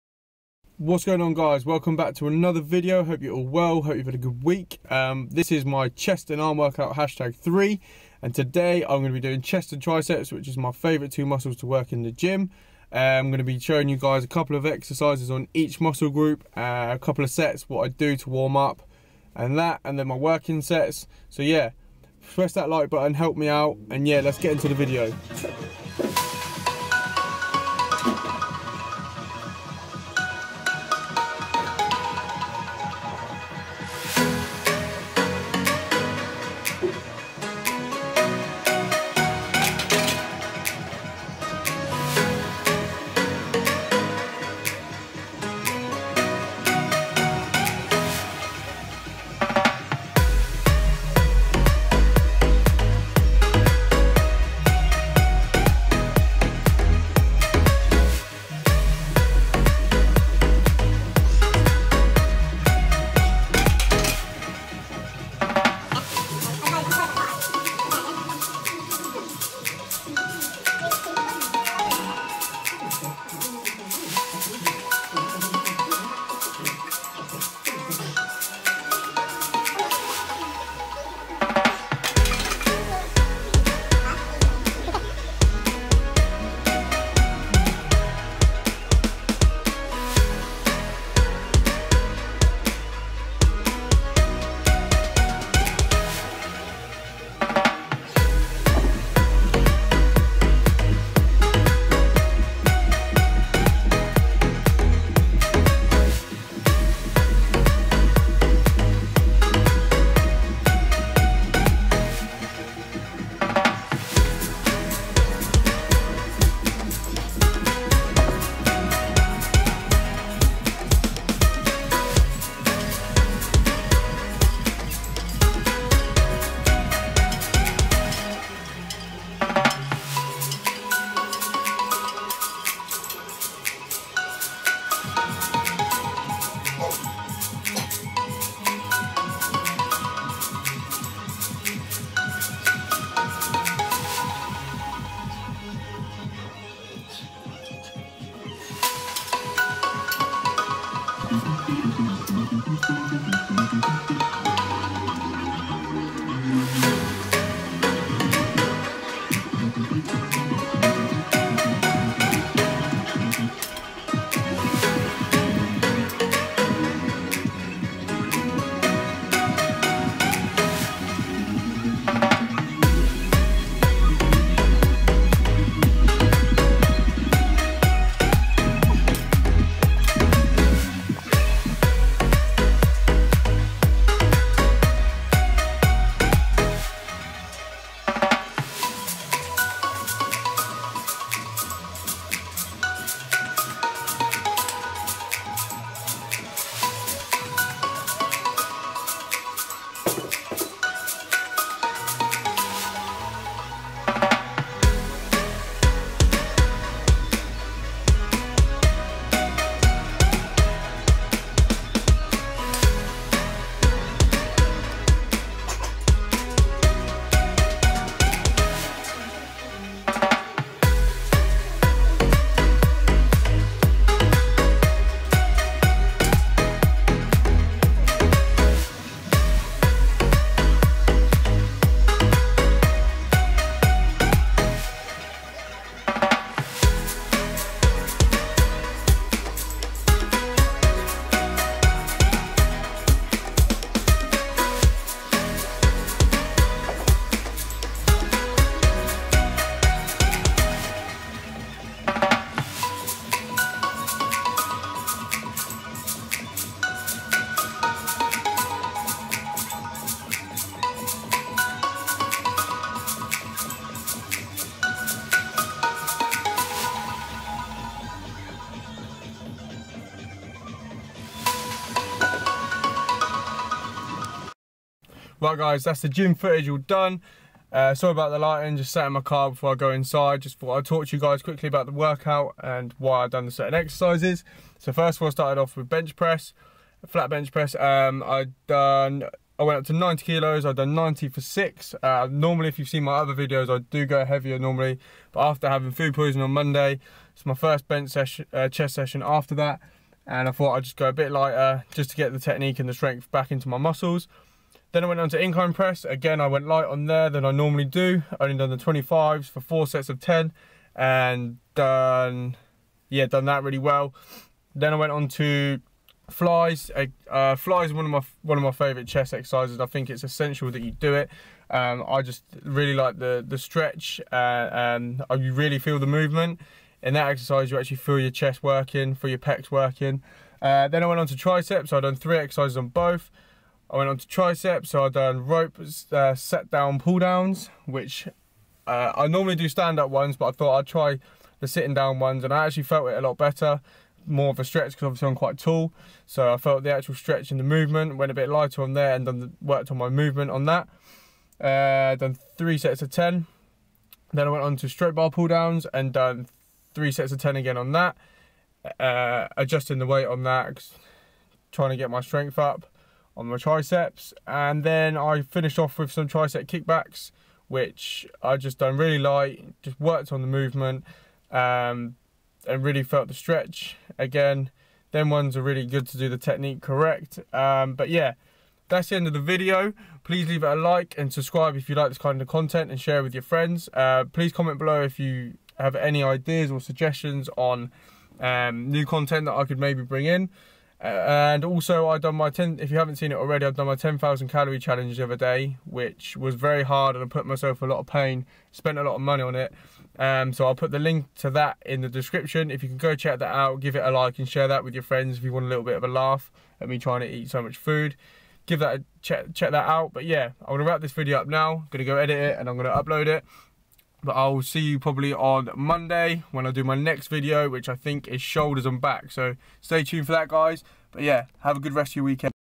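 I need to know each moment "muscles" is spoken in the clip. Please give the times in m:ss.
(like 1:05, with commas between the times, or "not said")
0:11, 0:15, 5:03.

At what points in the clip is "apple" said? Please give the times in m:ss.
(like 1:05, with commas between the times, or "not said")
not said.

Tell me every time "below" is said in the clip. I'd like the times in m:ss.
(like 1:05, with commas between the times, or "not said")
6:24.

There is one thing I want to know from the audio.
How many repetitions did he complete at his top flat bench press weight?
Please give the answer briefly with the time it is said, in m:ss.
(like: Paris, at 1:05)
6, at 4:51.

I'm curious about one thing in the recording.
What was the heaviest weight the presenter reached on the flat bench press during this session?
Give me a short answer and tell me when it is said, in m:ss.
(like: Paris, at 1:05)
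90 kilos, at 4:49.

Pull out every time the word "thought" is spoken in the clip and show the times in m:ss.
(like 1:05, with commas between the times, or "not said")
4:40, 5:00, 5:40.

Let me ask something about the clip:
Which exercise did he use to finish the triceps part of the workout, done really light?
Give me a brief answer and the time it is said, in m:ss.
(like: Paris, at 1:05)
tricep kickbacks, at 6:06.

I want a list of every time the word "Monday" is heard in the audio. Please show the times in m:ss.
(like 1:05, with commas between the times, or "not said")
4:56, 6:55.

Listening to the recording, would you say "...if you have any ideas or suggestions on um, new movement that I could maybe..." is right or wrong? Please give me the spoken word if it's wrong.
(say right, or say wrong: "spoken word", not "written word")
wrong: "content", not "movement".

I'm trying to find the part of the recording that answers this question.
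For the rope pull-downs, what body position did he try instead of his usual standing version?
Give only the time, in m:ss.
5:36.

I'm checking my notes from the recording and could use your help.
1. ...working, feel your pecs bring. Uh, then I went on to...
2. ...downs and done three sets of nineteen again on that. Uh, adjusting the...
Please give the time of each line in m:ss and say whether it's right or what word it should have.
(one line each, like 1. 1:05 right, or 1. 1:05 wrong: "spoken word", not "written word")
1. 5:28 wrong: "working", not "bring"
2. 5:55 wrong: "ten", not "nineteen".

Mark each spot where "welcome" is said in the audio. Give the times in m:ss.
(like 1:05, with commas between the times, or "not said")
0:01.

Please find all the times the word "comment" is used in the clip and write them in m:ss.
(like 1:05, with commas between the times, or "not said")
6:24.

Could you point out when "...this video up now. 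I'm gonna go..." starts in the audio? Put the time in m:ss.
6:51.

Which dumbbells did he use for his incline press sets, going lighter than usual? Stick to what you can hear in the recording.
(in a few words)
the 25s.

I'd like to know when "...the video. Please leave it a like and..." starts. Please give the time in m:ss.
6:19.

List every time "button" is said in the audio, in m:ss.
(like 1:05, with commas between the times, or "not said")
0:22.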